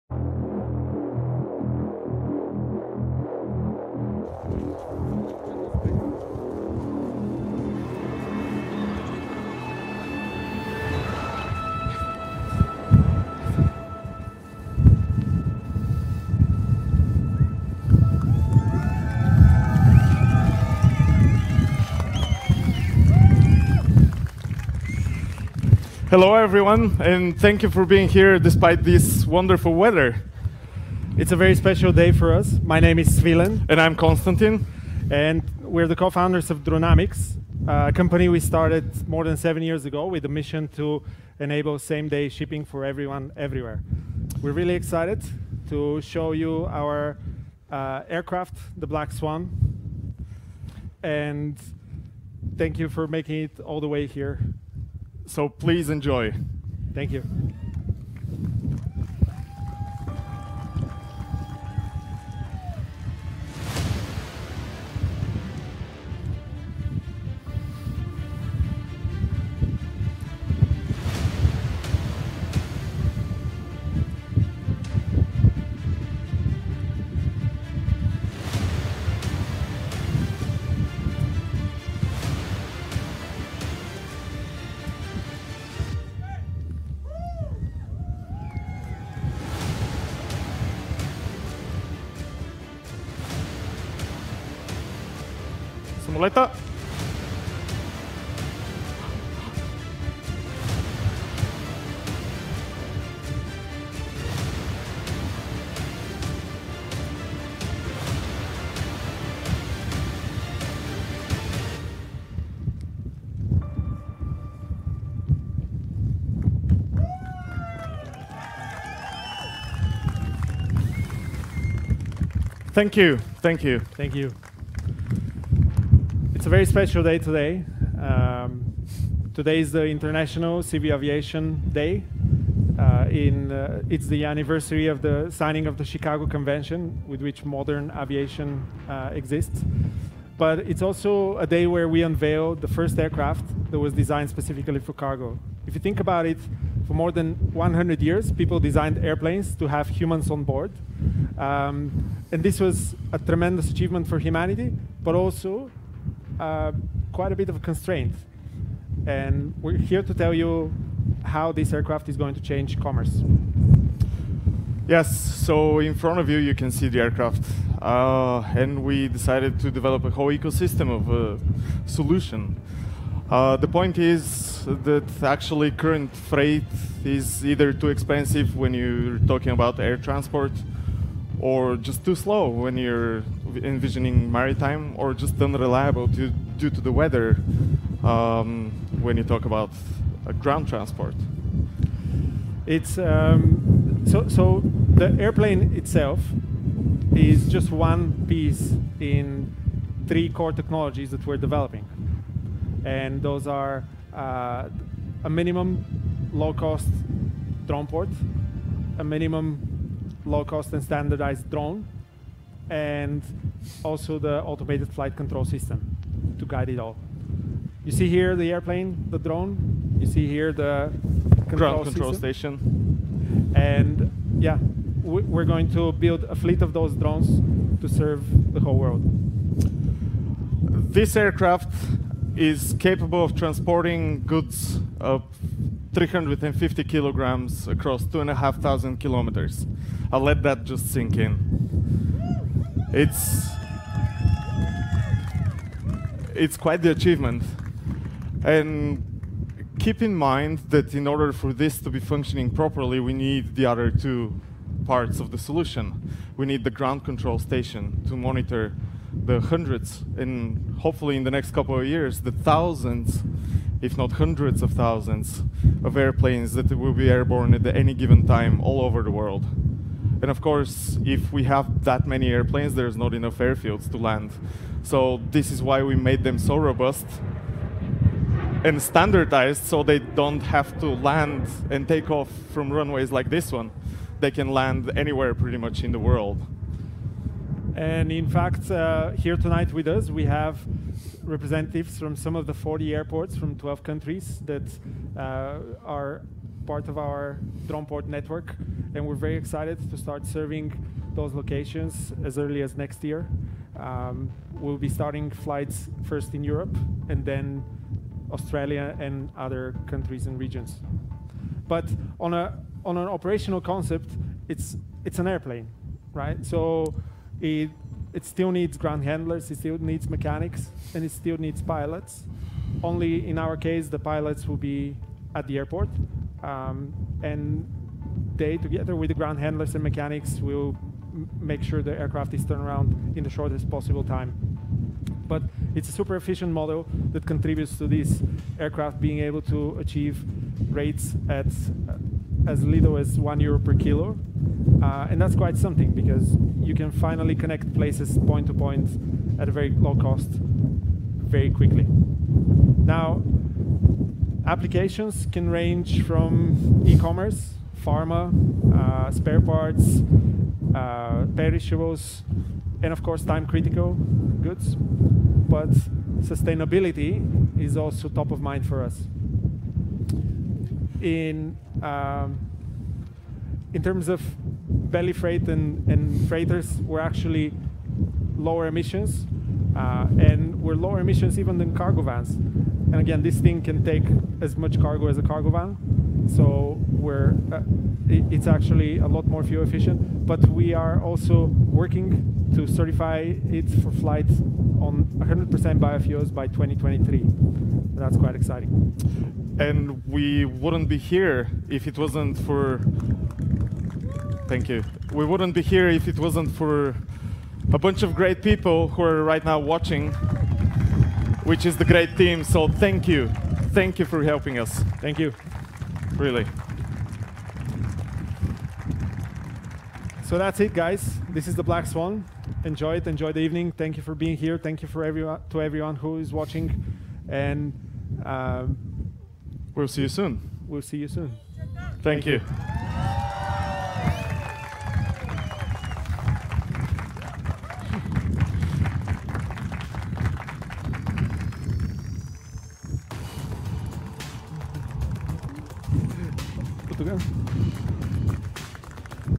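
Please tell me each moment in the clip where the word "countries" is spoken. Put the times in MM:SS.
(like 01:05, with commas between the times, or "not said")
04:53, 05:09.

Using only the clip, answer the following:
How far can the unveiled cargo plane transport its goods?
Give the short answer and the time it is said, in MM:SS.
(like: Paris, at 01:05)
2,500 kilometers, at 03:58.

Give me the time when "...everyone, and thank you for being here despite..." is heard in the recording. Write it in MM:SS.
00:26.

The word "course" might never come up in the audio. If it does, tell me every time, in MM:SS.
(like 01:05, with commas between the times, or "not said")
04:30, 06:03.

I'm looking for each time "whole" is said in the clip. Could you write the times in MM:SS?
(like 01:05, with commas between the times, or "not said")
02:50, 03:48.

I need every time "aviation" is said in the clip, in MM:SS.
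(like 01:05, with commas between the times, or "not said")
02:10, 02:17.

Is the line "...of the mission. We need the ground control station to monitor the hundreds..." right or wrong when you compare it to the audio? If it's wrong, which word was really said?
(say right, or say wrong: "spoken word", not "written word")
wrong: "solution", not "mission".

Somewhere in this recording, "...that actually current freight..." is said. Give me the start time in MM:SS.
02:54.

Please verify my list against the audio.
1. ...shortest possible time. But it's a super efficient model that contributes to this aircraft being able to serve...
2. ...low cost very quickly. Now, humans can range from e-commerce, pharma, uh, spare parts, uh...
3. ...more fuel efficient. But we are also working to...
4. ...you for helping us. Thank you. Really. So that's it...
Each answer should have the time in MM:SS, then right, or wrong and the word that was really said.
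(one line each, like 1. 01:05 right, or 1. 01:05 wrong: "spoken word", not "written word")
1. 05:33 wrong: "achieve", not "serve"
2. 05:49 wrong: "applications", not "humans"
3. 06:29 right
4. 06:53 right.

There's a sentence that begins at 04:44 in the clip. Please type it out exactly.
They can land anywhere pretty much in the world.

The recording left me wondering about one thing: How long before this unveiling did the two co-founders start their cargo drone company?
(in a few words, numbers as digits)
more than 7 years.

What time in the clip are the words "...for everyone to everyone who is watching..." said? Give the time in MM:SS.
07:04.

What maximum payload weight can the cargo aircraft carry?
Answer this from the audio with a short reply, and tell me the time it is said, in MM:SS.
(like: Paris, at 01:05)
350 kilograms, at 03:55.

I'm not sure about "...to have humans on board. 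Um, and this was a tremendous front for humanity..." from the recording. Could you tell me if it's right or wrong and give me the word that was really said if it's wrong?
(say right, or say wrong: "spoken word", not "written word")
wrong: "achievement", not "front".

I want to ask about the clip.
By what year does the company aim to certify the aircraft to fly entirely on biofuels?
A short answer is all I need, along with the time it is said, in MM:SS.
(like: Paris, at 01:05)
2023, at 06:36.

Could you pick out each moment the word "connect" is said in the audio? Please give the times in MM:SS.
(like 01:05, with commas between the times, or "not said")
05:47.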